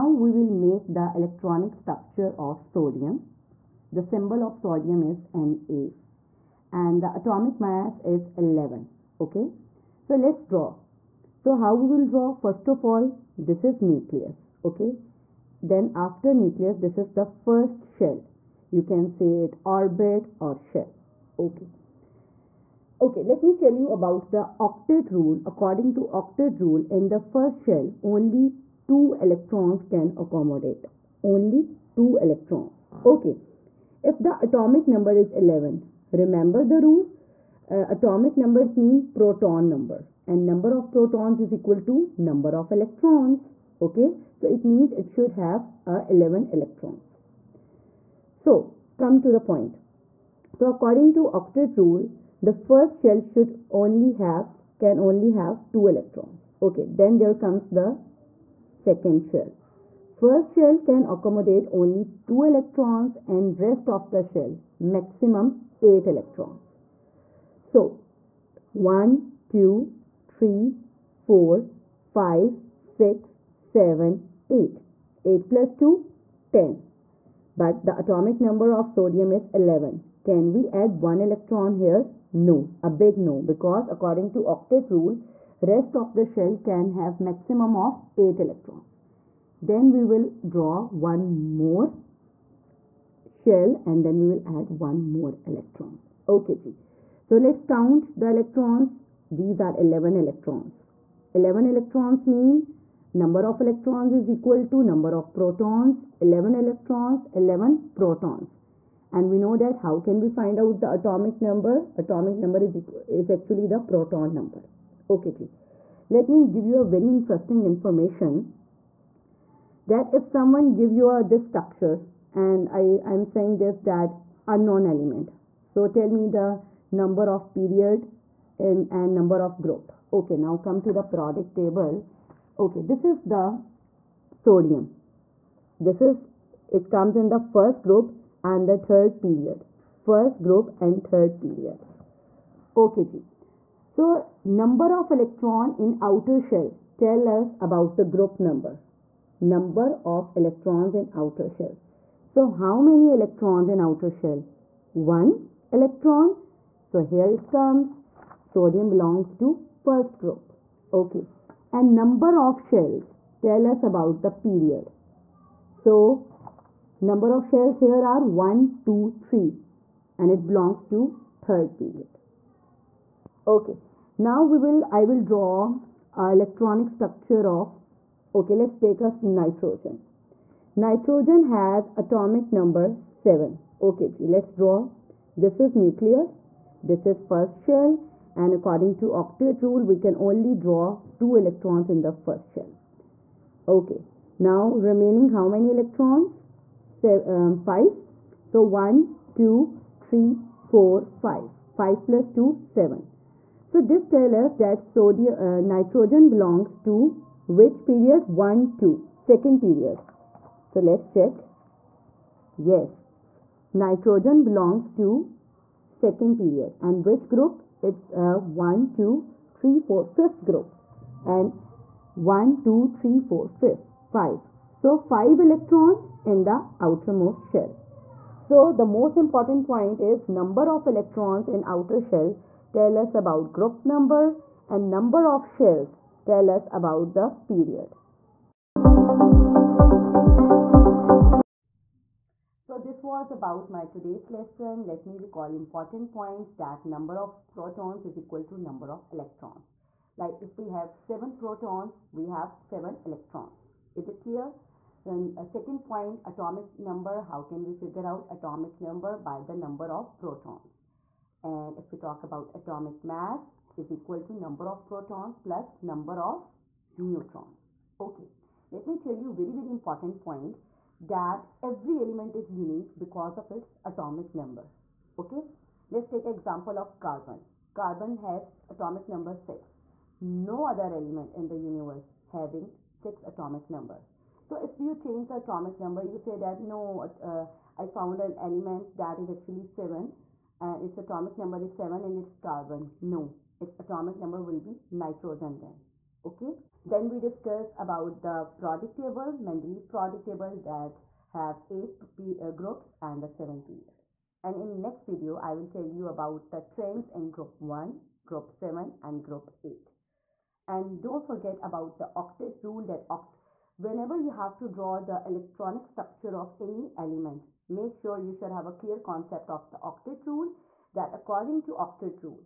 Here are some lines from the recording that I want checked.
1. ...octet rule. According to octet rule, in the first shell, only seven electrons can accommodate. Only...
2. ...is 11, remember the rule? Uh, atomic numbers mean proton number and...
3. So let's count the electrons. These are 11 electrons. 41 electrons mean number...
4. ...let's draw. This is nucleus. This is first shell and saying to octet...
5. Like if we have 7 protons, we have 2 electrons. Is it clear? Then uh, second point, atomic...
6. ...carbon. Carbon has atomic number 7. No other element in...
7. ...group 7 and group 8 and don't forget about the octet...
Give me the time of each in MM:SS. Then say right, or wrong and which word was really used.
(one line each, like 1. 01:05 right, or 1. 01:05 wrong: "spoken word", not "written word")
1. 00:24 wrong: "two", not "seven"
2. 00:35 right
3. 01:37 wrong: "11", not "41"
4. 03:04 wrong: "according", not "saying"
5. 04:10 wrong: "7", not "2"
6. 04:36 wrong: "6", not "7"
7. 05:08 right.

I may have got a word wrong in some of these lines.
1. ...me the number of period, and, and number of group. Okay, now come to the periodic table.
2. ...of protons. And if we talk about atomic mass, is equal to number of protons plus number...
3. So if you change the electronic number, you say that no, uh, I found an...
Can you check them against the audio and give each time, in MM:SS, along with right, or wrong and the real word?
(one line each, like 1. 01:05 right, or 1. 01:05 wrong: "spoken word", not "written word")
1. 02:06 right
2. 04:19 right
3. 04:44 wrong: "atomic", not "electronic".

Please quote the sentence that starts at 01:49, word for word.
And we know that how can we find out the atomic number?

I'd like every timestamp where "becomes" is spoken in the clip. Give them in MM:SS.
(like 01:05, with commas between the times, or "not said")
not said.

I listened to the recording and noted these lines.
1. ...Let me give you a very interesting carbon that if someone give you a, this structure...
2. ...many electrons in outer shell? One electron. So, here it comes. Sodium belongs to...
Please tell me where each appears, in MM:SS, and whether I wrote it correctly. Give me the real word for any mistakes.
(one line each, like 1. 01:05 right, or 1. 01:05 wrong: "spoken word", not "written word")
1. 01:56 wrong: "information", not "carbon"
2. 02:32 right.